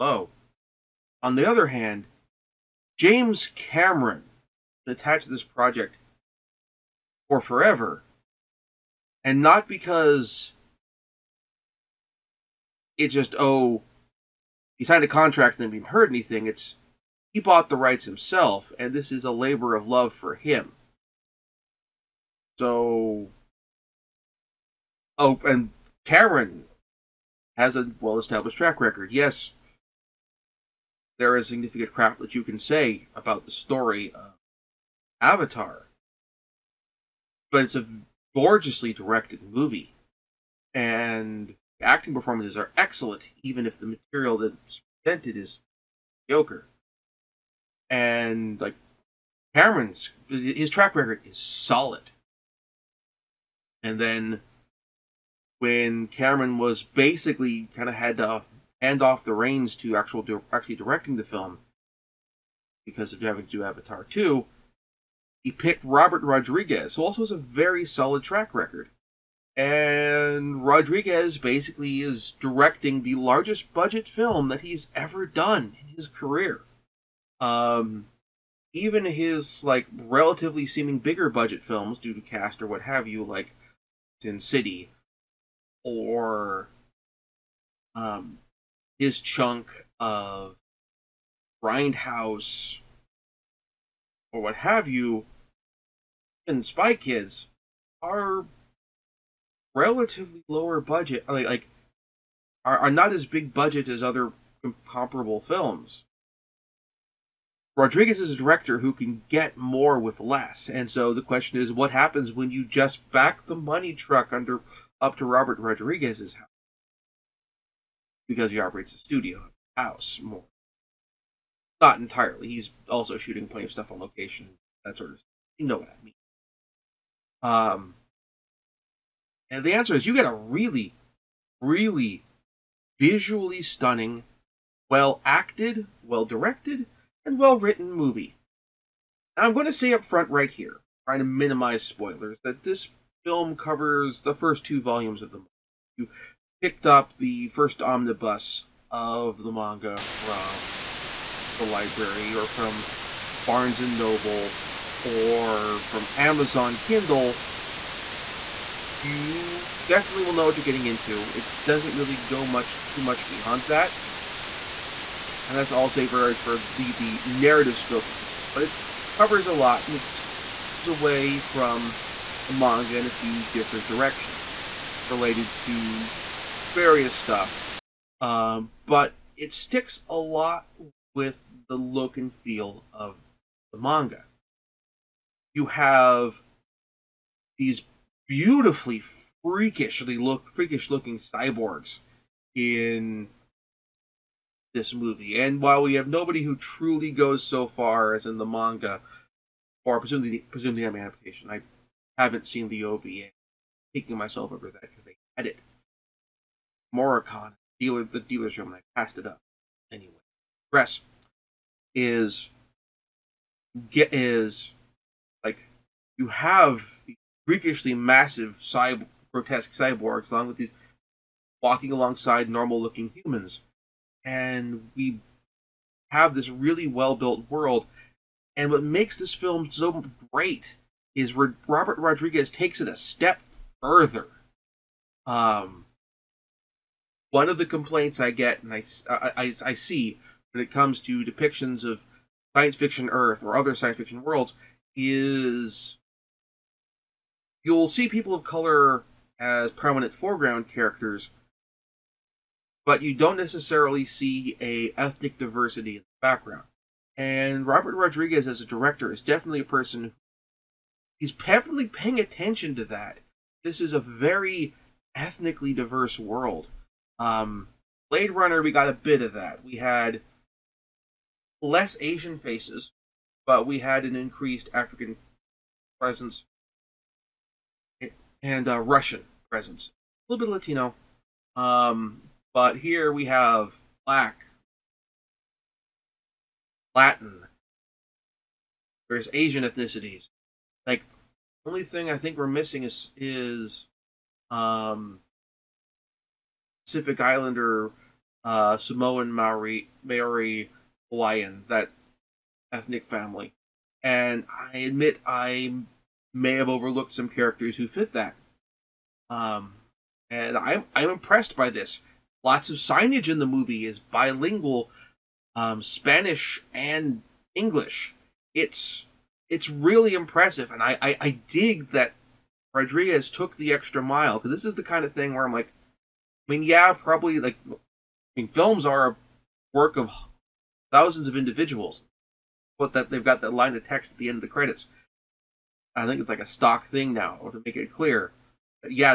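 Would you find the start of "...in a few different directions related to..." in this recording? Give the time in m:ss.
2:52.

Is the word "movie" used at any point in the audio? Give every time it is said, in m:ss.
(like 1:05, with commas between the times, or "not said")
0:39, 2:17, 3:14, 5:13.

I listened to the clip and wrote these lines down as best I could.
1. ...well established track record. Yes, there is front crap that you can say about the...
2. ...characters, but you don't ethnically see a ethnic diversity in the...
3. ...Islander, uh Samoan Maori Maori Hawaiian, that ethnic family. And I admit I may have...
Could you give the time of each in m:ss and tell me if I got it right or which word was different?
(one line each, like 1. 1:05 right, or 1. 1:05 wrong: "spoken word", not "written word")
1. 0:28 wrong: "significant", not "front"
2. 4:10 wrong: "necessarily", not "ethnically"
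3. 4:57 right.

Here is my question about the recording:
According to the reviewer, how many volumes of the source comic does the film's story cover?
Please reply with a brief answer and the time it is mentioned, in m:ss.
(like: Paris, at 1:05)
2, at 2:24.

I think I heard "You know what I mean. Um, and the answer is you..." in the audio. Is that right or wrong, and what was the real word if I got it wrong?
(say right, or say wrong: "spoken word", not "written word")
right.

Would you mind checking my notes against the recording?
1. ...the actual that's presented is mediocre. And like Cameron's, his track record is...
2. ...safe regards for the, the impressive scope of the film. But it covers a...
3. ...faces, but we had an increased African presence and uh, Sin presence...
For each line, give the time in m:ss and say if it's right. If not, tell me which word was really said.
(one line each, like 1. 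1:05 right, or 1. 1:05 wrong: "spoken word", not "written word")
1. 0:43 wrong: "material", not "actual"
2. 2:45 wrong: "narrative", not "impressive"
3. 4:32 wrong: "Russian", not "Sin".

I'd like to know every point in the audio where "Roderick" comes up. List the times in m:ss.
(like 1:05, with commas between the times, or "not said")
not said.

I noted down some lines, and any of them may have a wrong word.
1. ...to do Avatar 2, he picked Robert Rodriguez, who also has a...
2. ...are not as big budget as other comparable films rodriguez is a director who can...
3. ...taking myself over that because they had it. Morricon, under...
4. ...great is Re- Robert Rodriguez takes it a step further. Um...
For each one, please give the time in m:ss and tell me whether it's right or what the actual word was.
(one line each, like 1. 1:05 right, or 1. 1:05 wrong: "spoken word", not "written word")
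1. 1:03 right
2. 1:42 right
3. 3:23 wrong: "dealer", not "under"
4. 3:50 right.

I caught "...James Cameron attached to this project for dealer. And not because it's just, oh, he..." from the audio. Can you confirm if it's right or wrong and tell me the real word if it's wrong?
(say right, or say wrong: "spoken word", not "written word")
wrong: "forever", not "dealer".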